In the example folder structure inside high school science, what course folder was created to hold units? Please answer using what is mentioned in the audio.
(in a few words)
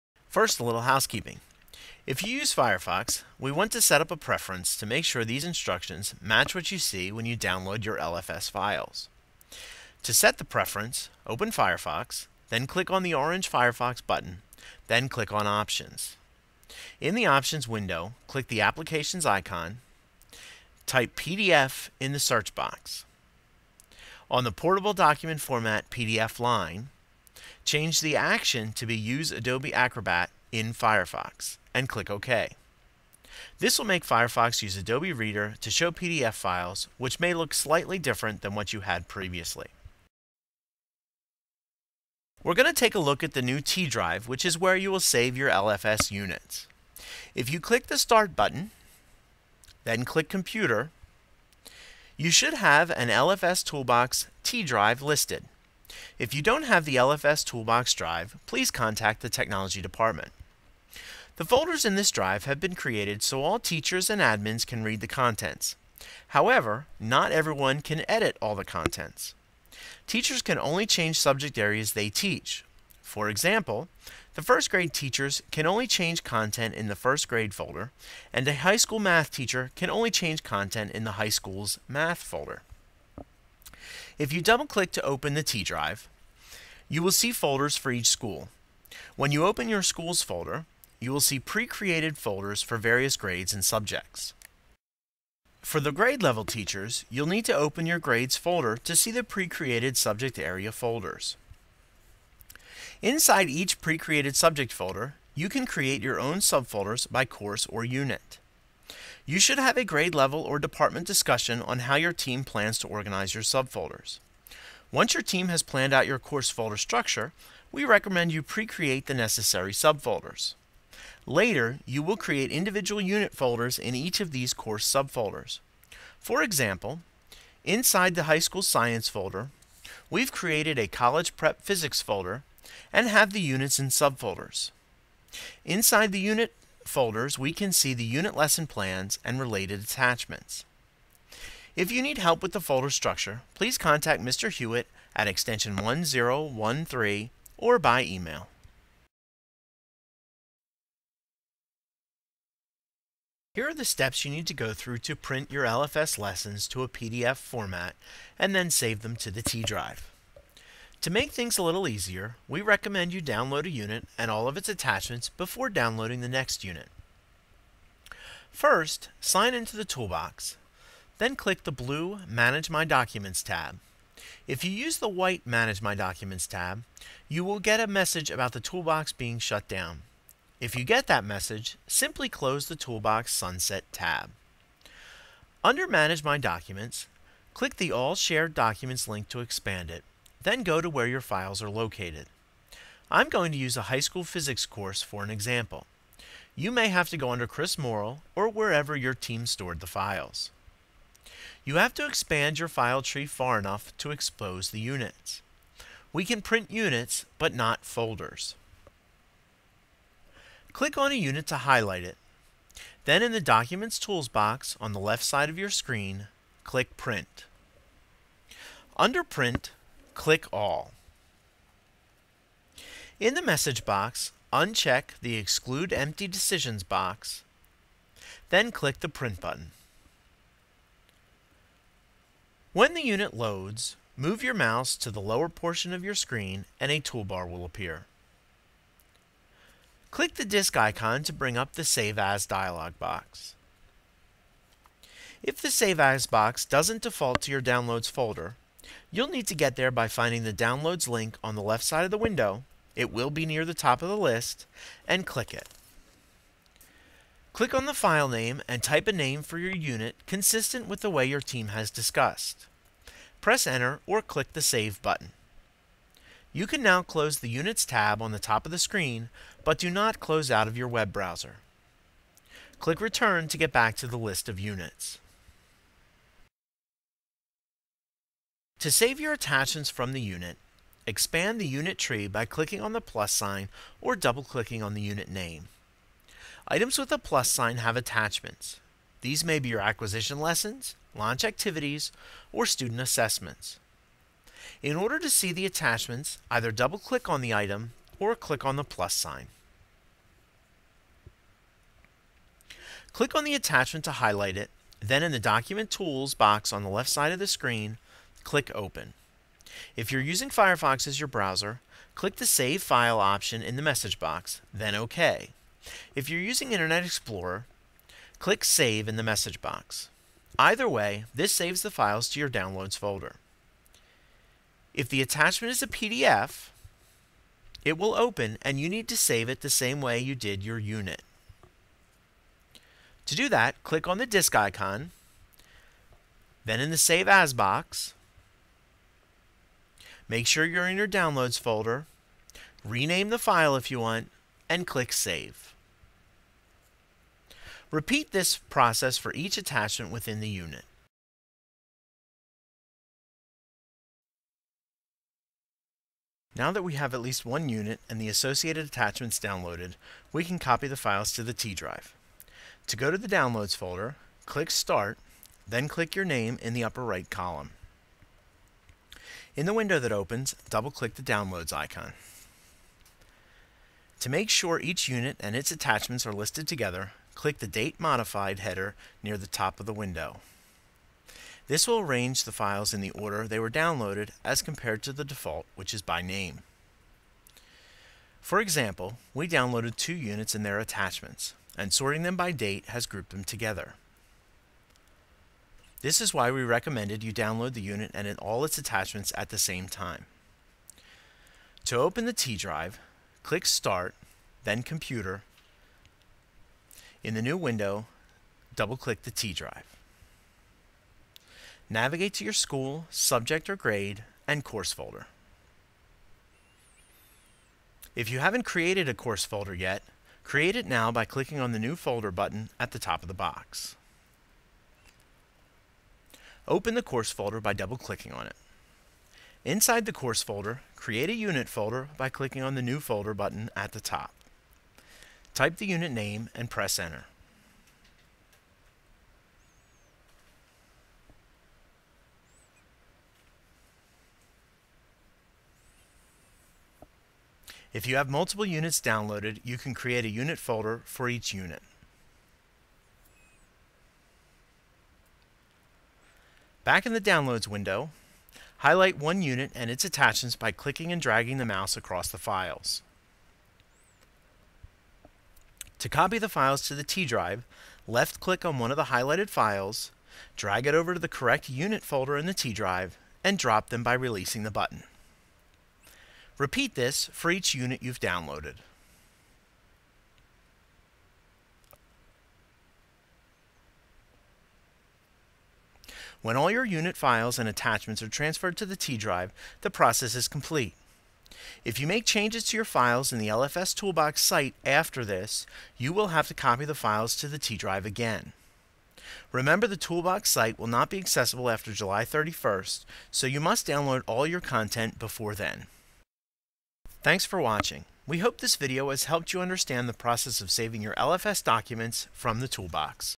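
College prep physics.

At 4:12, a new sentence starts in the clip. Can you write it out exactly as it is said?
It will be near the top of the list, and click it.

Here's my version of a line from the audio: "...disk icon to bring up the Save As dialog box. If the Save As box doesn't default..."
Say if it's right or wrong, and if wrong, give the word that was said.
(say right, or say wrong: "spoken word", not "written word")
right.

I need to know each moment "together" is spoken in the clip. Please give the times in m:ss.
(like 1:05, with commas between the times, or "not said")
6:16, 6:33.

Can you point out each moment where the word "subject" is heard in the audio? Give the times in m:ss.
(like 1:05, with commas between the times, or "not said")
1:11, 1:33, 1:39, 1:44, 6:53.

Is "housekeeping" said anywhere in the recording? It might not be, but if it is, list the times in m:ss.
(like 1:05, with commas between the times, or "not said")
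0:00.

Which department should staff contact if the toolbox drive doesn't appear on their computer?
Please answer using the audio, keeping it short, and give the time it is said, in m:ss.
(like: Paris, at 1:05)
Technology Department, at 0:59.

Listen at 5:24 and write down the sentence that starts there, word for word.
If the attachment is a PDF, it will open and you need to save it the same way you did your unit.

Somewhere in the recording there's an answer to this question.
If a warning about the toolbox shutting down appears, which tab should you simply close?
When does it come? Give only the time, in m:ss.
3:02.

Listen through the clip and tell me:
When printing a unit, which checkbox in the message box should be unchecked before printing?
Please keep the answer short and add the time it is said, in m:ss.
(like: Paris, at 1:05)
Exclude Empty Decisions, at 3:45.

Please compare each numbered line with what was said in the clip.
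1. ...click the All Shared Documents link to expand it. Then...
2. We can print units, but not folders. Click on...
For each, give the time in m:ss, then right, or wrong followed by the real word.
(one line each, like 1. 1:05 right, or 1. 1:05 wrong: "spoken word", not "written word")
1. 3:07 right
2. 3:26 right.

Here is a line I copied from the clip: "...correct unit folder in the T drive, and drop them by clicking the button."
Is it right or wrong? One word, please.
wrong.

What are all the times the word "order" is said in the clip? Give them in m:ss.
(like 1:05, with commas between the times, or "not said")
4:54, 6:23.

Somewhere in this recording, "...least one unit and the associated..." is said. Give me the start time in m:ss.
5:57.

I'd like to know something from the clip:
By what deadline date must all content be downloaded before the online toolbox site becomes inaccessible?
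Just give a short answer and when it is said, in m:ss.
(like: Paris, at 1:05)
July 31st, at 8:21.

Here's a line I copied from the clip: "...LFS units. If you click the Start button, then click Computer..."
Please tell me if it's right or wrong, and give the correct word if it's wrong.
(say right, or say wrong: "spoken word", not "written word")
right.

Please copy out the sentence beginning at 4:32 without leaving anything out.
Click Return to get back to the list of units.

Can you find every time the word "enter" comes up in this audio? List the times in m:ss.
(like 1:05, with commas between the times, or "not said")
4:23, 7:16.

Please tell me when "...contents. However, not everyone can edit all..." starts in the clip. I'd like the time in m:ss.
1:05.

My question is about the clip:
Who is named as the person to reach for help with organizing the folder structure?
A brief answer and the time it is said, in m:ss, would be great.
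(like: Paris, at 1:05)
Mr. Hewitt, at 2:24.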